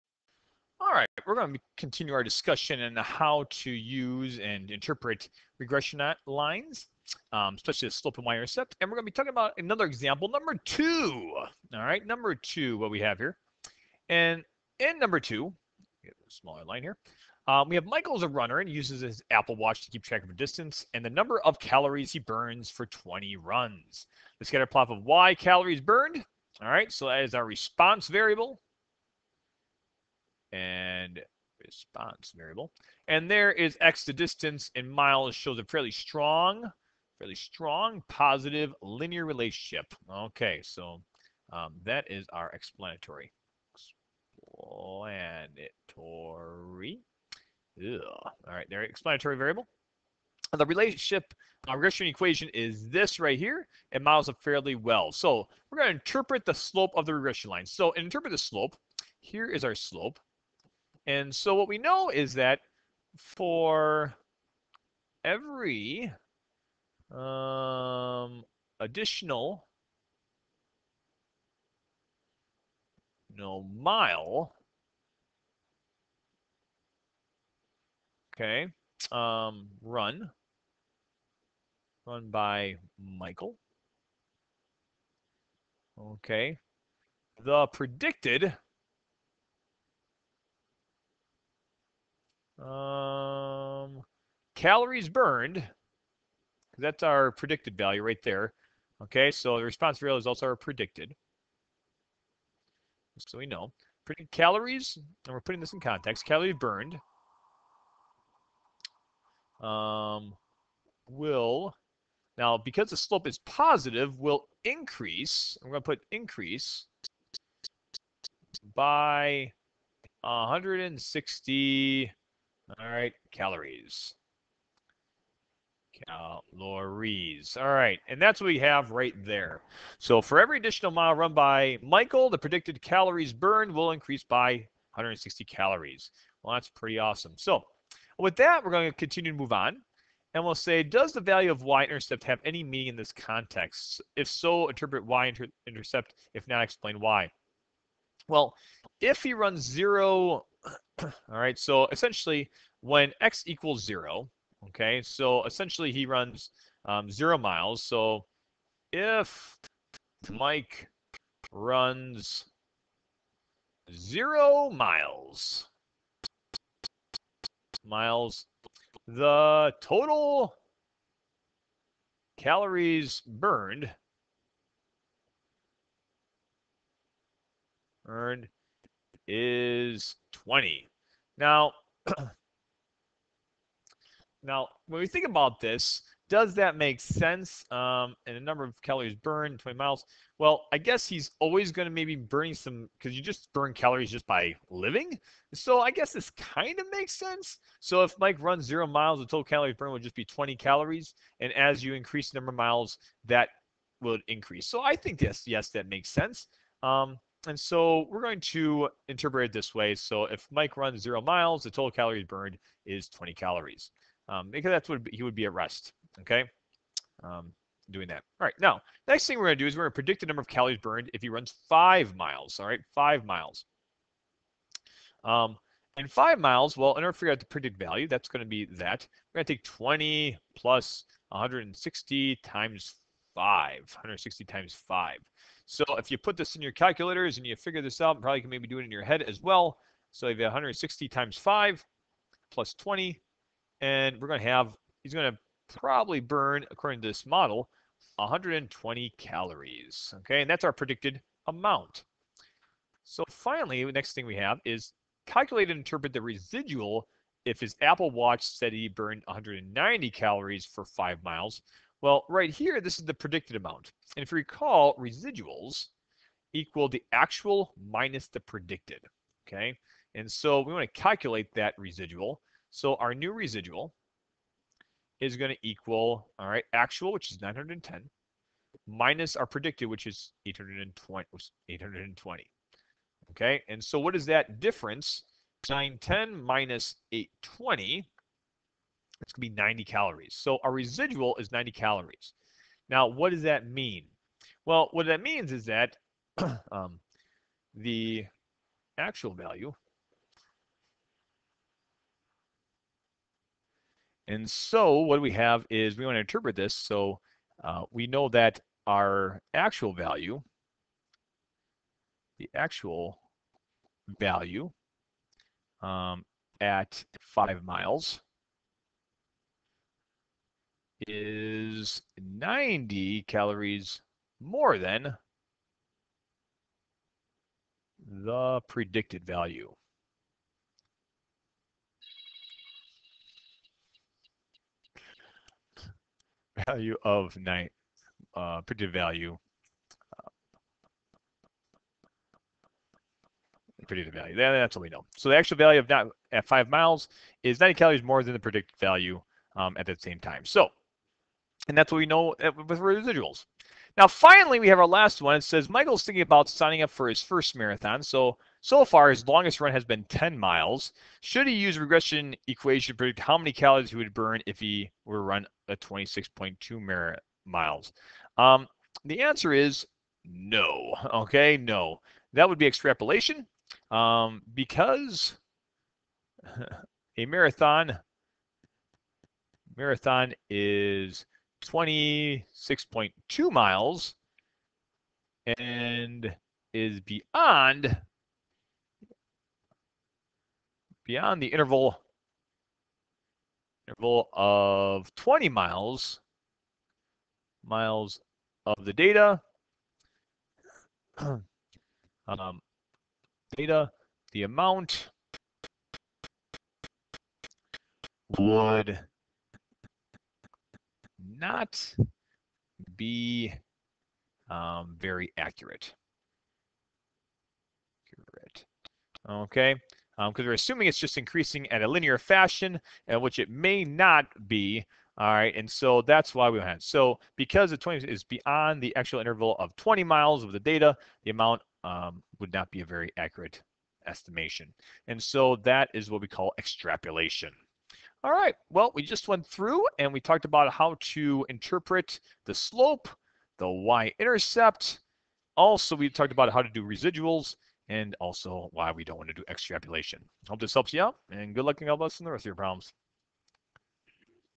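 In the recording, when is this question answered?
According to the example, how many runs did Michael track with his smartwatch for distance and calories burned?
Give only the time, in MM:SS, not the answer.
00:22.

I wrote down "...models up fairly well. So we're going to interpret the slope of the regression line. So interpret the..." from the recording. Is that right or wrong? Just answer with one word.
right.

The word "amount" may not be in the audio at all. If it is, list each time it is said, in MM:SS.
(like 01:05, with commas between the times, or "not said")
04:11, 04:23, 06:44, 07:11.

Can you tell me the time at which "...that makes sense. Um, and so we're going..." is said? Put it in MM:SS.
03:25.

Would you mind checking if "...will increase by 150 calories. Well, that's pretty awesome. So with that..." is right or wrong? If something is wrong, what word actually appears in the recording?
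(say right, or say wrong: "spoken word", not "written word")
wrong: "160", not "150".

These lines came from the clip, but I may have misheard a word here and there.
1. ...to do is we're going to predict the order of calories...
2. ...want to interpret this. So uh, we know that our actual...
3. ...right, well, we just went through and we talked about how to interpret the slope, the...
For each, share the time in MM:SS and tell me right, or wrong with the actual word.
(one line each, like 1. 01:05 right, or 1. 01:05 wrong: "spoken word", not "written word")
1. 03:39 wrong: "number", not "order"
2. 05:06 right
3. 07:18 right.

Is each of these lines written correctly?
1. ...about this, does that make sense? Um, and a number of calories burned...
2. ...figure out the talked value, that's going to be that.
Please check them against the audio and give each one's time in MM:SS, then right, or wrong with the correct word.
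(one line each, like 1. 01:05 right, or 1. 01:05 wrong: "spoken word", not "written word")
1. 03:05 right
2. 03:47 wrong: "predicted", not "talked".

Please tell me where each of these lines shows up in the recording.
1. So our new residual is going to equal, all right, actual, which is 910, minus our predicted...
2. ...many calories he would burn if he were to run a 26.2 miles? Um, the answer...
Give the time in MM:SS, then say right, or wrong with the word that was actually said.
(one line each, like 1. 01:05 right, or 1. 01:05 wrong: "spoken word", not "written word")
1. 04:32 right
2. 06:03 right.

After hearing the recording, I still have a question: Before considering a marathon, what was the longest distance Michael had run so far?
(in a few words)
10 miles.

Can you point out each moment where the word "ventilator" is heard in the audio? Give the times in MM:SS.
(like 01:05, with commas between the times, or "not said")
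not said.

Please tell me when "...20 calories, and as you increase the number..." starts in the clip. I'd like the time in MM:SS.
03:20.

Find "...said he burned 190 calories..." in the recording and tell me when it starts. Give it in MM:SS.
04:18.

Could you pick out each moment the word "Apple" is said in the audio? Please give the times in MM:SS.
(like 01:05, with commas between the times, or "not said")
00:19, 04:17.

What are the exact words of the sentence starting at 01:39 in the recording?
Okay, so the response real results are predicted.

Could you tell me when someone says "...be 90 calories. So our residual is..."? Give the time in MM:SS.
04:49.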